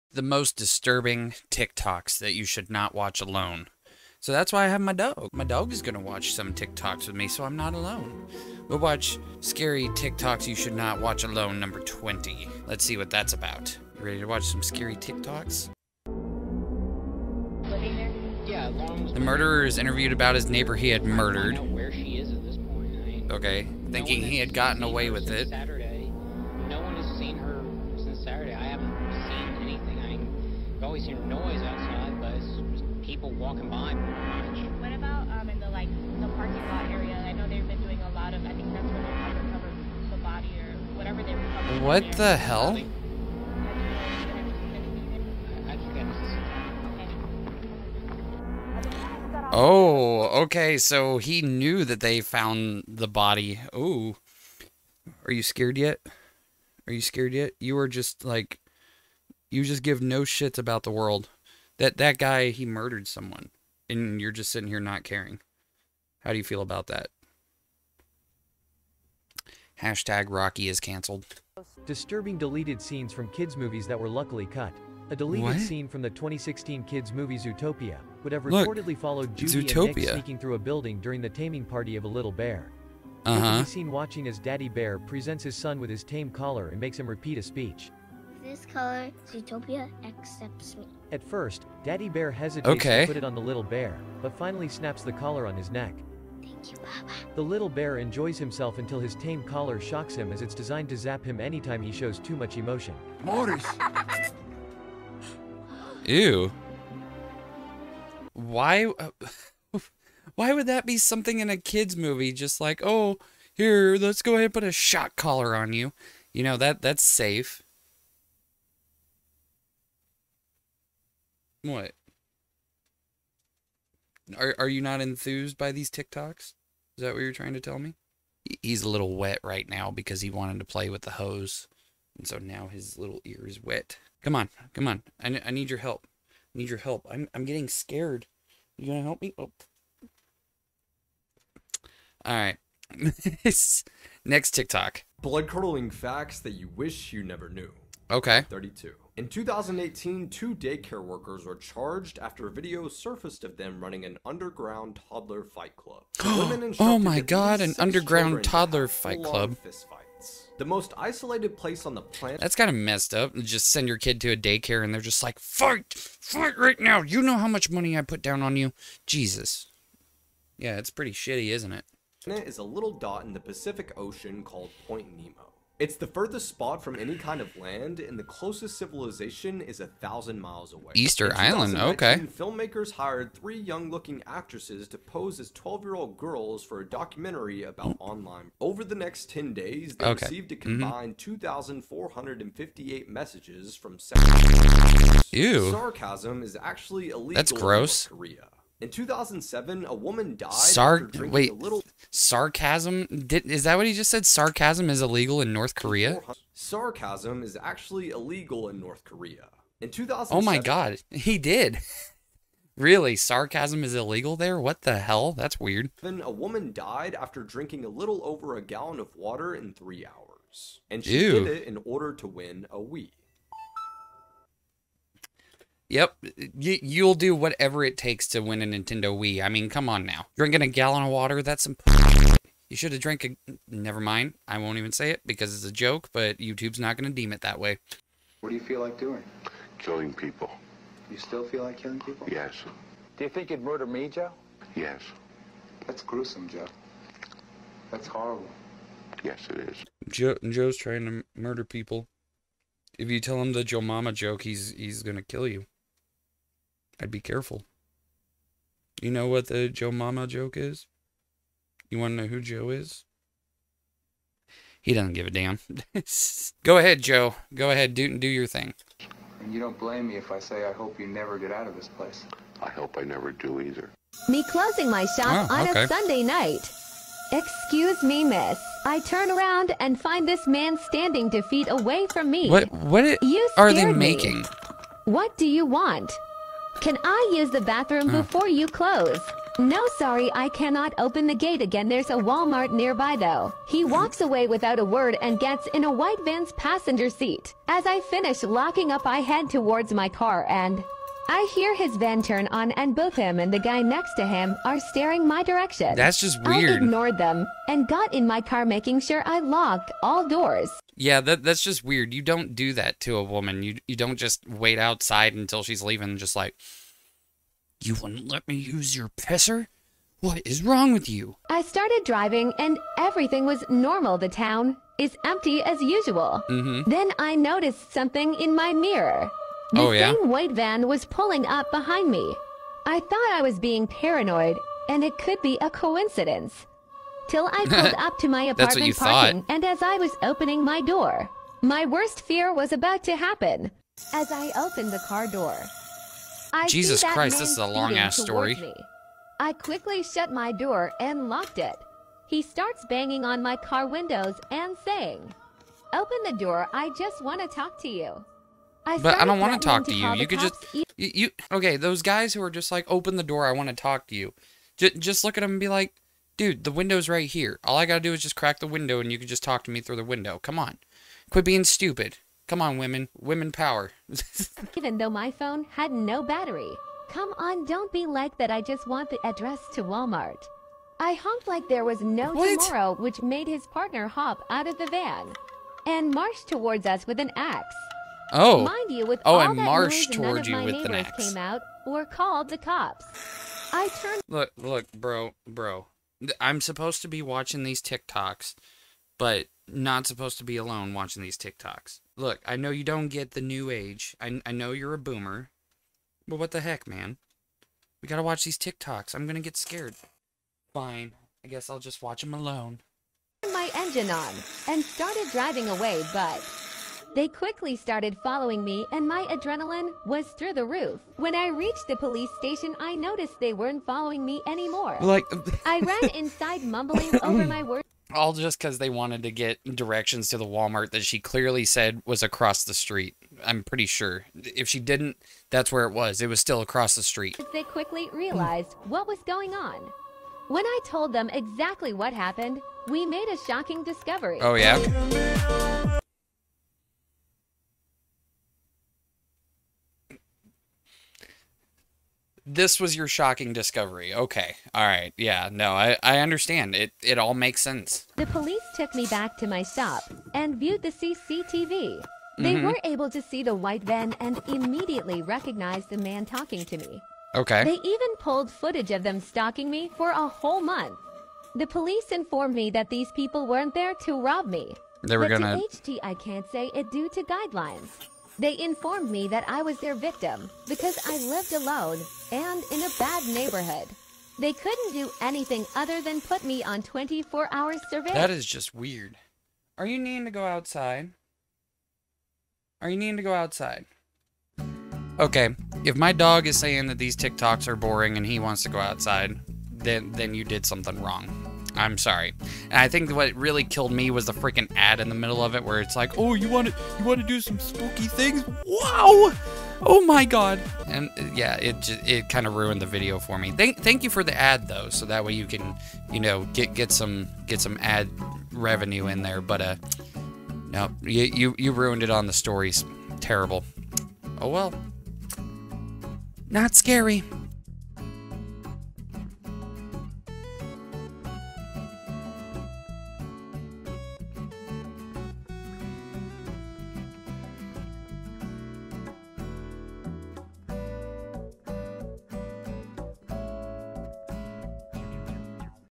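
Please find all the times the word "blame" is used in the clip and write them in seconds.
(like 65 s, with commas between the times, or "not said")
269 s.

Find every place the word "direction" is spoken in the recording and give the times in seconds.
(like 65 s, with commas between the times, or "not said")
305 s, 429 s.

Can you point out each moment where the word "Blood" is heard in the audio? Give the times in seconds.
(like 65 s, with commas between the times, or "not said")
145 s.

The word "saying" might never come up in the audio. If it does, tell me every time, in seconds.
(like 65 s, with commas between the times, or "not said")
354 s, 496 s.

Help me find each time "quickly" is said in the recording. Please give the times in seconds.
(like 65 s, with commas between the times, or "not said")
349 s, 417 s, 437 s.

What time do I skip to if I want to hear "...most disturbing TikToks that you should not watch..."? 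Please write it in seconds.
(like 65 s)
0 s.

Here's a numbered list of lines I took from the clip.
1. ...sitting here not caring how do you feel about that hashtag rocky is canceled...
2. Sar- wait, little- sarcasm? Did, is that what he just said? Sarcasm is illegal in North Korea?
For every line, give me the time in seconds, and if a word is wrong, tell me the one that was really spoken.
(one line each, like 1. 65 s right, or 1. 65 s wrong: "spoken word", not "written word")
1. 64 s right
2. 200 s right.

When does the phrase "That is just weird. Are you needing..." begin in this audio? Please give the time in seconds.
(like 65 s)
488 s.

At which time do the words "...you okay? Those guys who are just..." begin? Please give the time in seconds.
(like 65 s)
360 s.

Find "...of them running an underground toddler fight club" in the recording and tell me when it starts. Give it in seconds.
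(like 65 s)
153 s.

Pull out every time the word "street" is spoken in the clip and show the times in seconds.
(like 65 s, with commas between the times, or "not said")
432 s, 437 s.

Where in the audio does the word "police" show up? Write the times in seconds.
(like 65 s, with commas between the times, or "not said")
421 s, 458 s, 471 s.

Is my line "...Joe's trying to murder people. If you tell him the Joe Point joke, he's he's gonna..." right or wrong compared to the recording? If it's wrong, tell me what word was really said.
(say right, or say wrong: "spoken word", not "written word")
wrong: "Mama", not "Point".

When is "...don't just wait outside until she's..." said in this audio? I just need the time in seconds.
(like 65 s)
313 s.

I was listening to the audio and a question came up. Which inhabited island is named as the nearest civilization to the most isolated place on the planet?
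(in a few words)
Easter Island.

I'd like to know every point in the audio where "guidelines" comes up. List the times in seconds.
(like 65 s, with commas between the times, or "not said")
477 s.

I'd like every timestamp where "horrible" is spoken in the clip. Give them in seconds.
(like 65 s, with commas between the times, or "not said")
248 s.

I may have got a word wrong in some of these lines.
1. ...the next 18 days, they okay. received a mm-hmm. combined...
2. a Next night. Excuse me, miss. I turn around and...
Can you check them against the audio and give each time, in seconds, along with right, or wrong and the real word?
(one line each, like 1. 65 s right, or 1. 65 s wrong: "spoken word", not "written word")
1. 188 s wrong: "10", not "18"
2. 275 s wrong: "Sunday", not "Next".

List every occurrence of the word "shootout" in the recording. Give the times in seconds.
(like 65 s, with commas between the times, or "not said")
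not said.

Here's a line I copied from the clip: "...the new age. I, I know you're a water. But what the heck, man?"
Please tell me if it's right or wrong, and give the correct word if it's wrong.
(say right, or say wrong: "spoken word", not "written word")
wrong: "boomer", not "water".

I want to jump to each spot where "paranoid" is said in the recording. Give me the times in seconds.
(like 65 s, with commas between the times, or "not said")
333 s.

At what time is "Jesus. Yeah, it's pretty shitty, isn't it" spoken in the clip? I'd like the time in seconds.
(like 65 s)
169 s.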